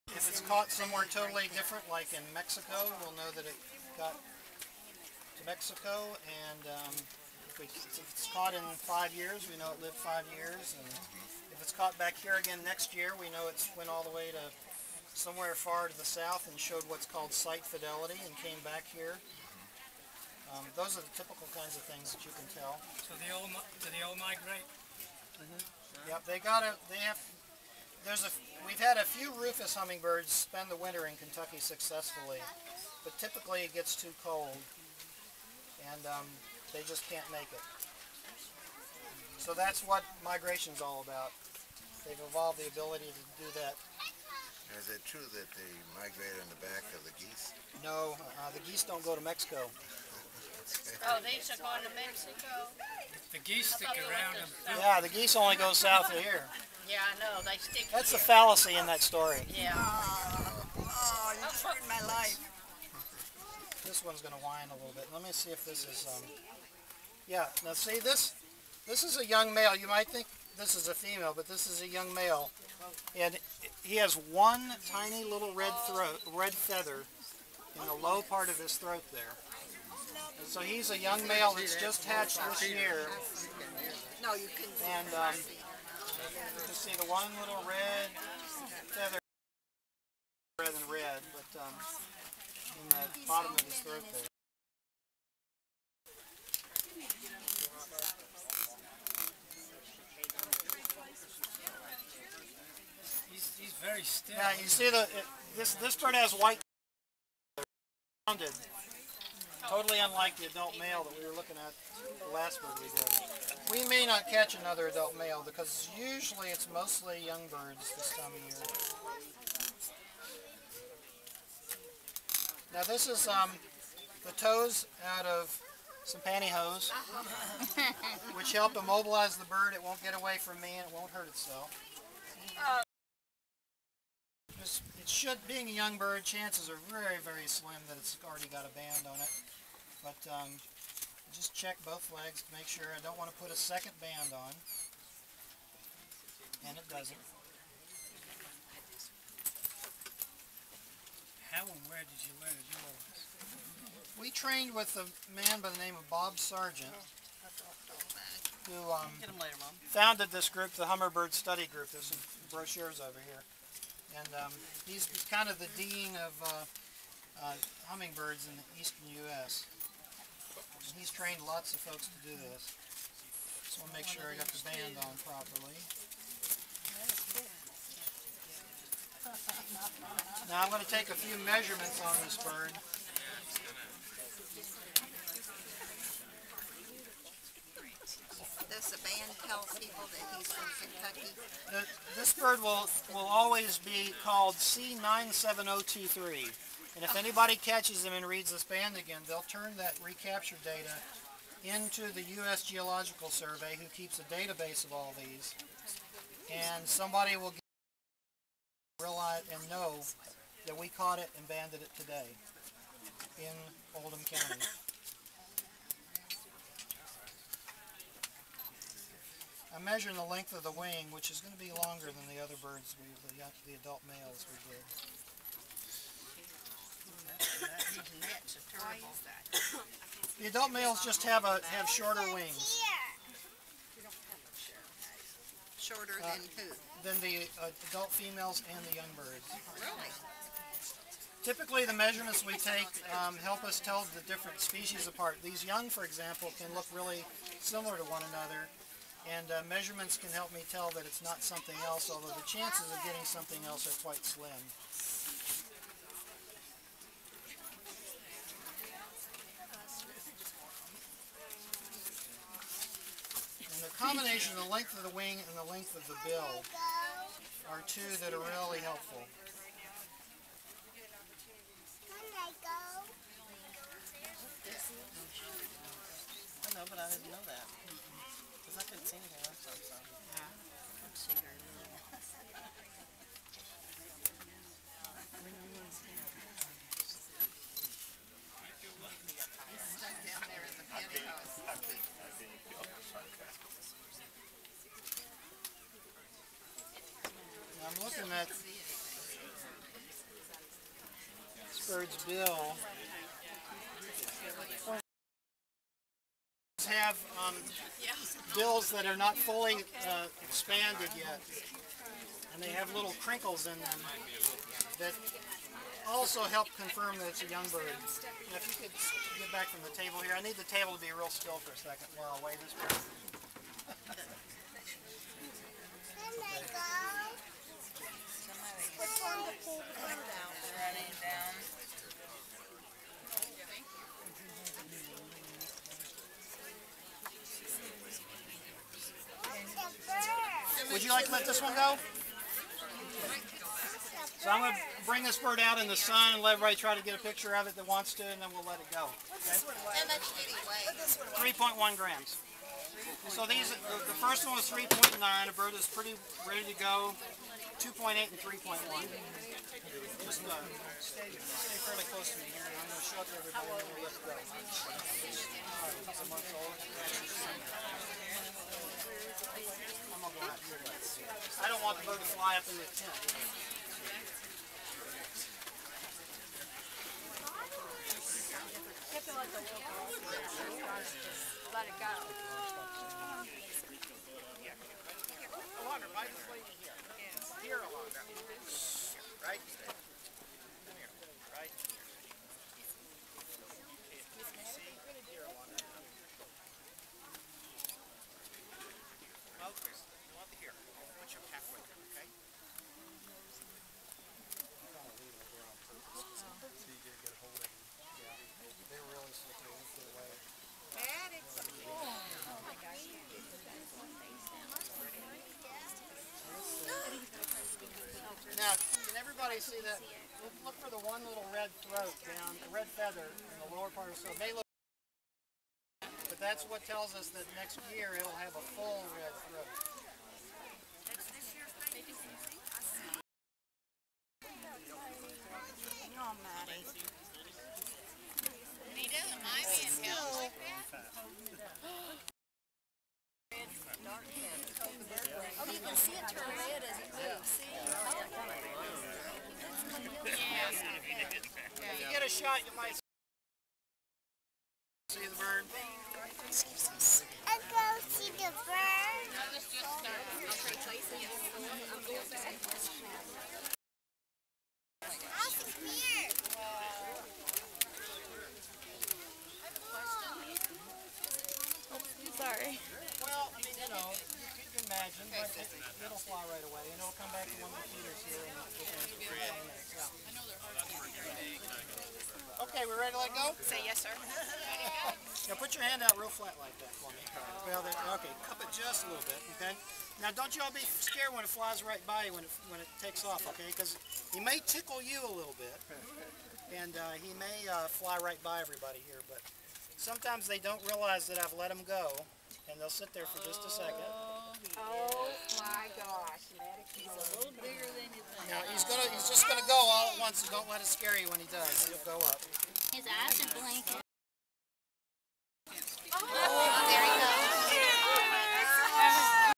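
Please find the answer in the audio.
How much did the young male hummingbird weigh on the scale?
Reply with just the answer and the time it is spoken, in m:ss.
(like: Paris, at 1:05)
3.1 grams, at 5:51.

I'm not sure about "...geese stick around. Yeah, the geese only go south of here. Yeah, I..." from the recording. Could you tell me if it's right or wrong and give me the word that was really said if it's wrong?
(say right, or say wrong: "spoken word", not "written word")
right.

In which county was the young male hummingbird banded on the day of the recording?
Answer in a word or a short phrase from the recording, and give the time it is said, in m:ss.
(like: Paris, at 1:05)
Oldham County, at 3:34.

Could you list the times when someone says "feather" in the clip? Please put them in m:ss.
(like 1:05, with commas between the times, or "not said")
1:16, 1:28, 7:02.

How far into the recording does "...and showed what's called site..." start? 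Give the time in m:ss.
0:16.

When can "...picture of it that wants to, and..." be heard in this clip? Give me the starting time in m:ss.
5:47.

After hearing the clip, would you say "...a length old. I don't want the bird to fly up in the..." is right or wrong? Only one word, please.
wrong.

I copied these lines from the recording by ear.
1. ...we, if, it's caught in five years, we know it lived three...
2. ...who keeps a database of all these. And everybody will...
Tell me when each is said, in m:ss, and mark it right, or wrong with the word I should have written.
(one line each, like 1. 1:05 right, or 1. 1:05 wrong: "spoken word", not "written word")
1. 0:07 wrong: "five", not "three"
2. 3:23 wrong: "somebody", not "everybody".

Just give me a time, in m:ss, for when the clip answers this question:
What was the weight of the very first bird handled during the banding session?
5:54.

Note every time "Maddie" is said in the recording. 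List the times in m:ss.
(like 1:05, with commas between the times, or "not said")
7:16.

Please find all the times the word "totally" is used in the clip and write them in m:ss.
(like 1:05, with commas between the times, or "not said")
0:01, 1:49.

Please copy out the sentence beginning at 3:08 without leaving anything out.
This band tells people that he's from Kentucky?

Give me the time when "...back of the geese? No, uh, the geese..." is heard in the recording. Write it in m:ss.
0:46.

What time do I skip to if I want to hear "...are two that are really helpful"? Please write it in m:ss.
4:27.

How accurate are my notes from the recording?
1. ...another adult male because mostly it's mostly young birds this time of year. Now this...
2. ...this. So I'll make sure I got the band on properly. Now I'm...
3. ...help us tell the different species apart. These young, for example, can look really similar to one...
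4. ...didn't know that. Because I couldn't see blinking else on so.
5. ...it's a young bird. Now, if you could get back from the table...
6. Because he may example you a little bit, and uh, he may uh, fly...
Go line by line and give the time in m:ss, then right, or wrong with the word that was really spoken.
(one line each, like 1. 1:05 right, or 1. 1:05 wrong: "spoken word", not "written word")
1. 1:54 wrong: "usually", not "mostly"
2. 2:52 right
3. 4:03 right
4. 4:37 wrong: "anything", not "blinking"
5. 5:17 right
6. 8:13 wrong: "tickle", not "example".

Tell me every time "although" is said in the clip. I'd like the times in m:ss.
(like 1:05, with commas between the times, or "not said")
4:12.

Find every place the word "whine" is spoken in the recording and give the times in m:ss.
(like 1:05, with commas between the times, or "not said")
1:04.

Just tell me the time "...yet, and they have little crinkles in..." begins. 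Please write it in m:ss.
5:11.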